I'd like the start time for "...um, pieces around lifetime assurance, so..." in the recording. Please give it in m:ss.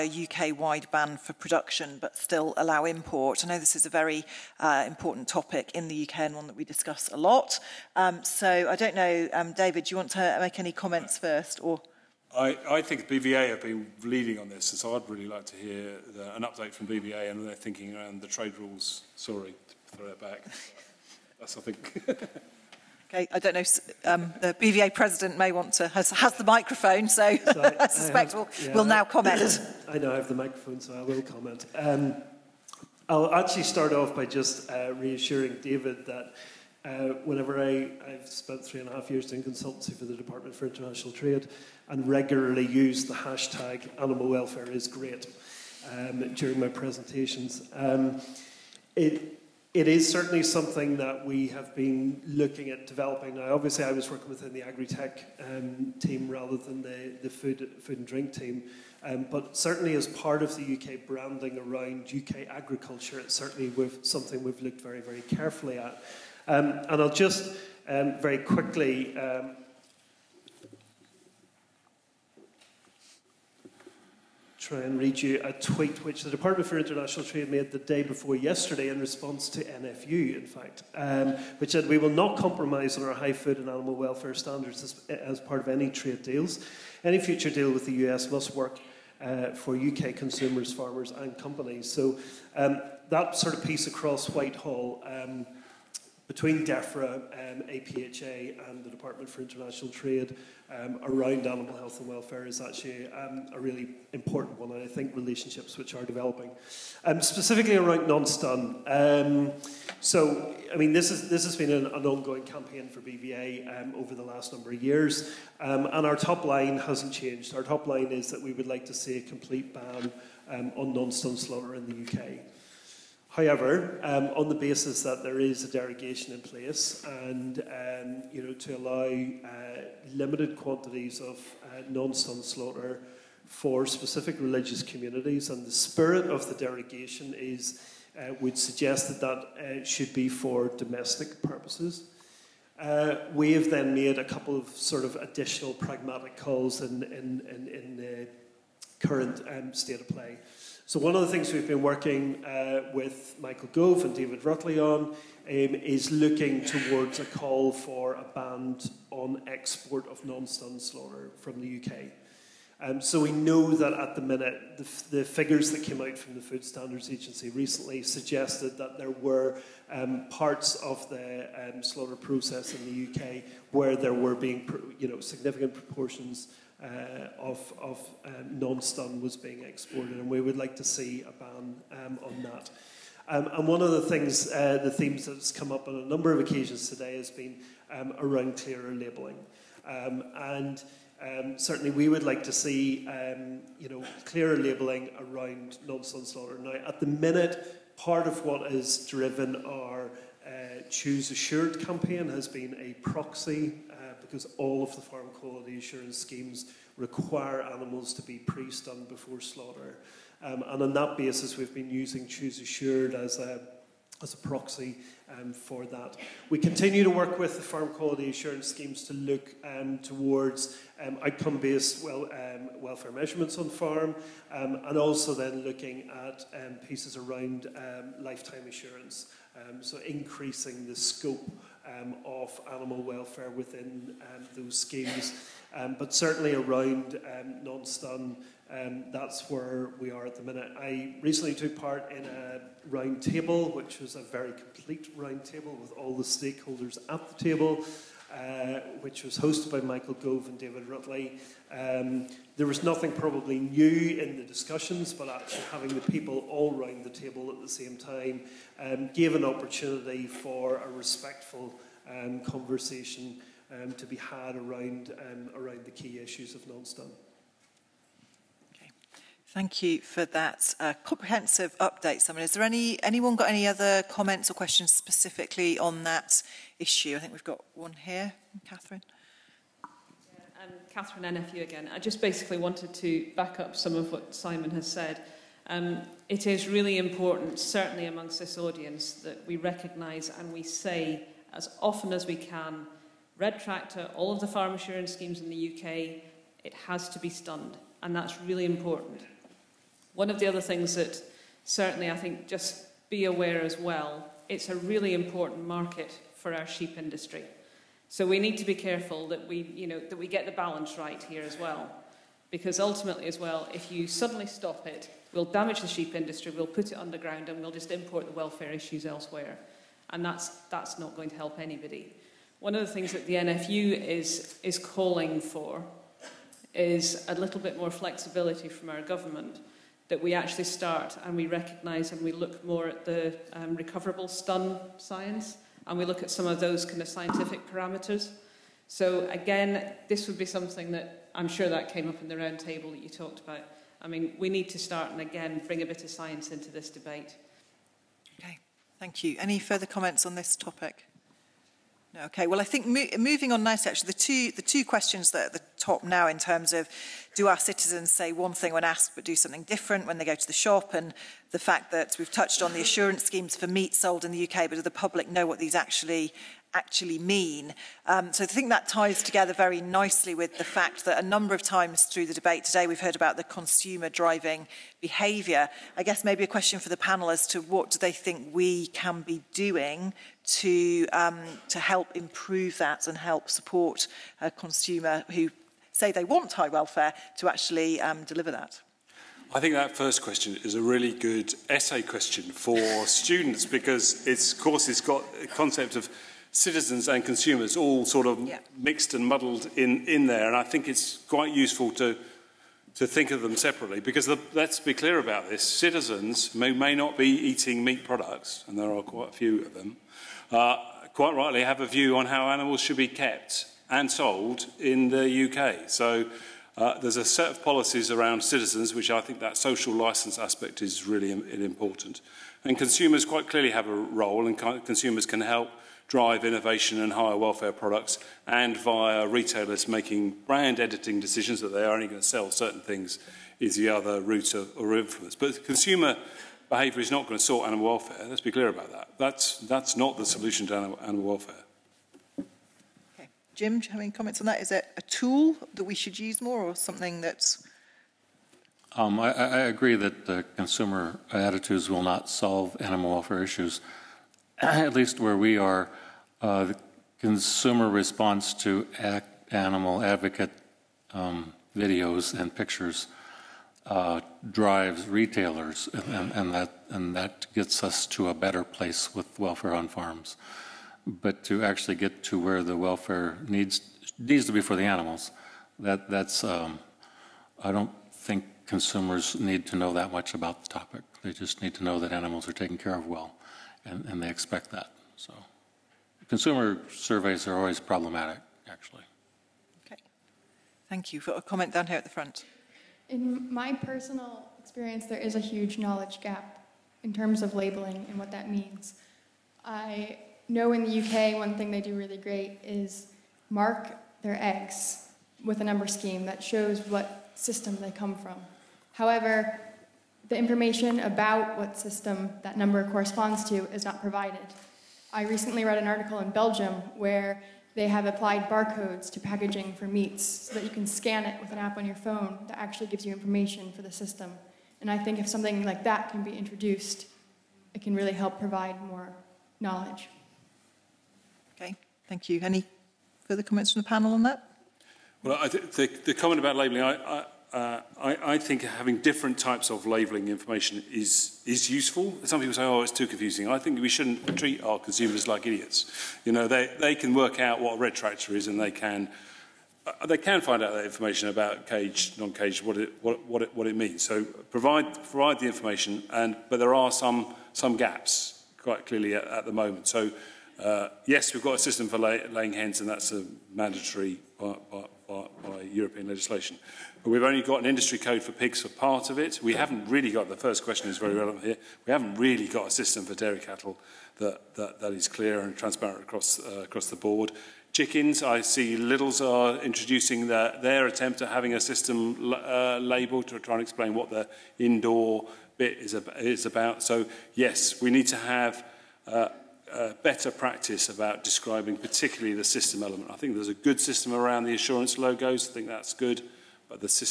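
3:46.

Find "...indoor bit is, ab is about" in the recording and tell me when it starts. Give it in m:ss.
9:44.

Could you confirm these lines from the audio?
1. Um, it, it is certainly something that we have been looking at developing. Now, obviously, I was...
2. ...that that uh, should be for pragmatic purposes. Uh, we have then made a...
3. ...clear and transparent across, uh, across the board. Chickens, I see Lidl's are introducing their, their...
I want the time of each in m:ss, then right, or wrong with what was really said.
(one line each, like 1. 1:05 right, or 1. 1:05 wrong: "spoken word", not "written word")
1. 0:47 right
2. 2:19 wrong: "domestic", not "pragmatic"
3. 9:35 right.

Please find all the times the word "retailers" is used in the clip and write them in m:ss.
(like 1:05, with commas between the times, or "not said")
7:09, 7:45.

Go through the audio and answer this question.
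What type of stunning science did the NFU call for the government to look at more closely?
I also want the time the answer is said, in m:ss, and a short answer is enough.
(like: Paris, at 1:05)
recoverable stun, at 5:33.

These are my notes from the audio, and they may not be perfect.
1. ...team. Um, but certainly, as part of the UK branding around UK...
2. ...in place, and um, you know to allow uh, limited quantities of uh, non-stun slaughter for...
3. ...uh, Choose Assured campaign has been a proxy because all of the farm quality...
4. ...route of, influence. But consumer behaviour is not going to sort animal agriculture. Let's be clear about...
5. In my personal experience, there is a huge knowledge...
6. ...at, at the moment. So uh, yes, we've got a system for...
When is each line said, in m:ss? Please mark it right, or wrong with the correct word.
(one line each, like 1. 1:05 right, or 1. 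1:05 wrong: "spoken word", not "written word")
1. 0:58 right
2. 2:06 right
3. 3:20 right
4. 7:14 wrong: "welfare", not "agriculture"
5. 8:13 right
6. 9:19 right.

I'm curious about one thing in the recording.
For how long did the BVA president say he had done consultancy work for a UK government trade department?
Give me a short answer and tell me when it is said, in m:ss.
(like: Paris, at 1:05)
3 and a half years, at 0:38.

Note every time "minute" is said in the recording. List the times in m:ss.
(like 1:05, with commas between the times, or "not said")
2:44, 3:17, 4:00.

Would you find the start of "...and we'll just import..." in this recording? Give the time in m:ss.
5:17.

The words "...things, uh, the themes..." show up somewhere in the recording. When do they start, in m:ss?
3:04.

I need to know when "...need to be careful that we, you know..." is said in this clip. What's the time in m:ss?
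5:08.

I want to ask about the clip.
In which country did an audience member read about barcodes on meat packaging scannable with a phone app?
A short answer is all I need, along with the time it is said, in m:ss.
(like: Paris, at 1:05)
Belgium, at 8:36.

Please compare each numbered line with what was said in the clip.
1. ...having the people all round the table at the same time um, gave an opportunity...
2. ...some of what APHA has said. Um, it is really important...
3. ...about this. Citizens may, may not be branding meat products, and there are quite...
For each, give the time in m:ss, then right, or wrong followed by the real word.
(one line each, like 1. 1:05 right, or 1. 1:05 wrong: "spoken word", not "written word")
1. 4:15 right
2. 4:43 wrong: "Simon", not "APHA"
3. 6:45 wrong: "eating", not "branding".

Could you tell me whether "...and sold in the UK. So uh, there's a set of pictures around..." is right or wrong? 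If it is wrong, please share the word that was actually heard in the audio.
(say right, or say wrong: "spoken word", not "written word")
wrong: "policies", not "pictures".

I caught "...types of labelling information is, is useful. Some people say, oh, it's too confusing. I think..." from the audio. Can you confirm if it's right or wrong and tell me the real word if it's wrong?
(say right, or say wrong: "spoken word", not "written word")
right.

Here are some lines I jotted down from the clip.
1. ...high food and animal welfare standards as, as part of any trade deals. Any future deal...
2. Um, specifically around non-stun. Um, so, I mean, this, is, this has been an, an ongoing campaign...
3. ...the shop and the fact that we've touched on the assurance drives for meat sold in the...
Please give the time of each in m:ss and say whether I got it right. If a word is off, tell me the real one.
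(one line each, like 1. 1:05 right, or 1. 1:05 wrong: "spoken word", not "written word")
1. 1:23 right
2. 1:47 right
3. 6:00 wrong: "schemes", not "drives".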